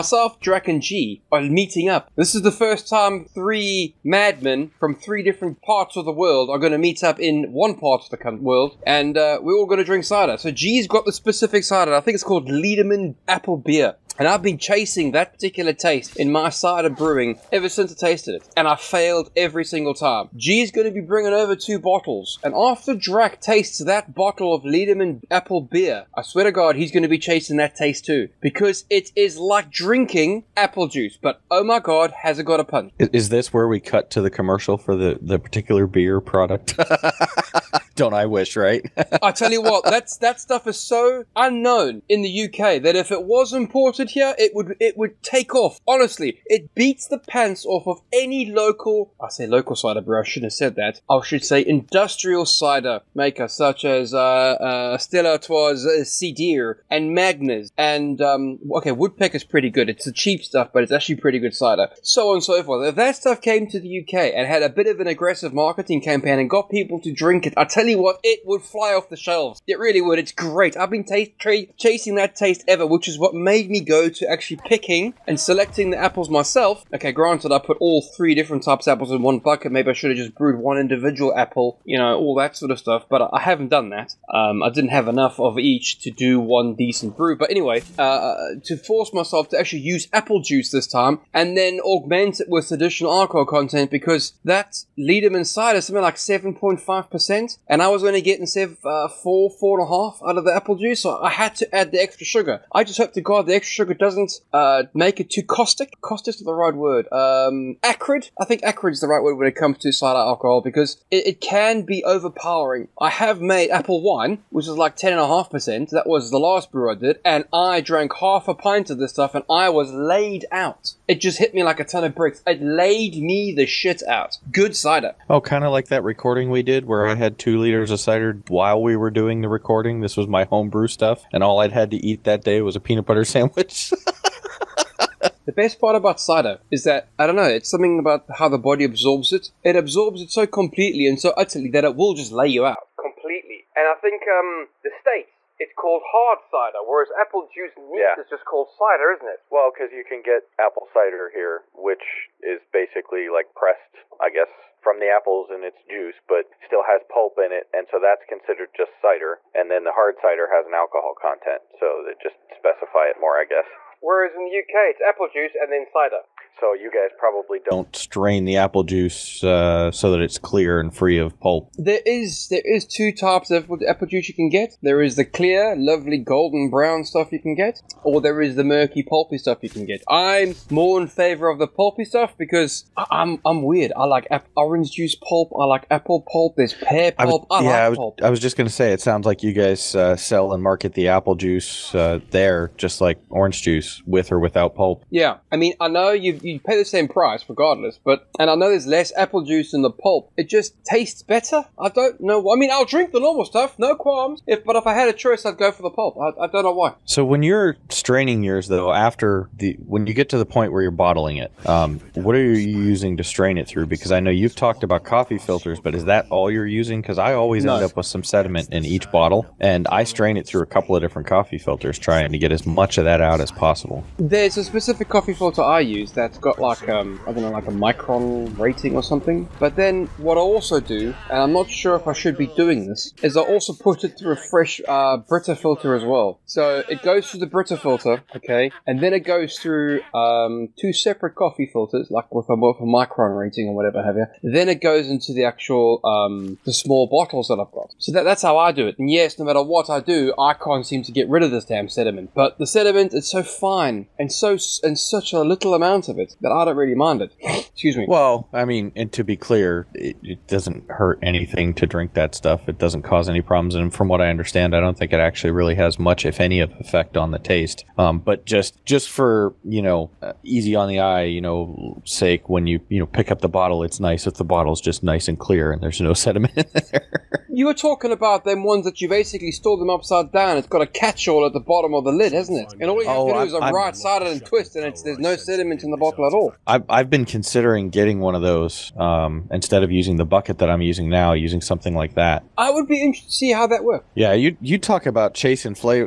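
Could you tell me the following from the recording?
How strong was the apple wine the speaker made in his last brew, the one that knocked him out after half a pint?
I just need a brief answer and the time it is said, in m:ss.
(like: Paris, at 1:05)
10.5%, at 1:54.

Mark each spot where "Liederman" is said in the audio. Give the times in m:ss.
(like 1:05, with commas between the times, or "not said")
0:12, 0:24, 1:34.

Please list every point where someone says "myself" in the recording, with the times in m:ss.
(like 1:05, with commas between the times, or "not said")
1:16, 1:29.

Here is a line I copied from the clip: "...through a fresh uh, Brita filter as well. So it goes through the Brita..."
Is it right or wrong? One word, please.
right.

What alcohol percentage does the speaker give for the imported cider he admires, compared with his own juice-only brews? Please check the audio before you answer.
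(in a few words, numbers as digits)
7.5%.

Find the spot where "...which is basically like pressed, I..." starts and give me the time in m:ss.
2:31.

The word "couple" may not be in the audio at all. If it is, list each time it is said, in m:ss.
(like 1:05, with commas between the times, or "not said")
3:40.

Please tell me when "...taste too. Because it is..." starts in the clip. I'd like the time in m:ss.
0:27.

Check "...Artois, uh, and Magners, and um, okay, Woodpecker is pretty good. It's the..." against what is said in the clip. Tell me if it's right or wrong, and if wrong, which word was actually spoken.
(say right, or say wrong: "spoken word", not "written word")
right.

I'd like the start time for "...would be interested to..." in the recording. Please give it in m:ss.
4:52.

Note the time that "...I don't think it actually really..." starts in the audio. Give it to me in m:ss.
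4:24.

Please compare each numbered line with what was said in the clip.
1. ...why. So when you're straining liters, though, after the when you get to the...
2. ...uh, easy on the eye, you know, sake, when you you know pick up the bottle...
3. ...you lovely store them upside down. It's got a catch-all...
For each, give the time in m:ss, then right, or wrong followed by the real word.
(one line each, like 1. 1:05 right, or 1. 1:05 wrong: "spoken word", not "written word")
1. 3:26 wrong: "yours", not "liters"
2. 4:30 right
3. 4:39 wrong: "basically", not "lovely".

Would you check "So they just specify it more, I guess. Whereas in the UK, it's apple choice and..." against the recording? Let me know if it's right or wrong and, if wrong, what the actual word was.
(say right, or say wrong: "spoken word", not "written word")
wrong: "juice", not "choice".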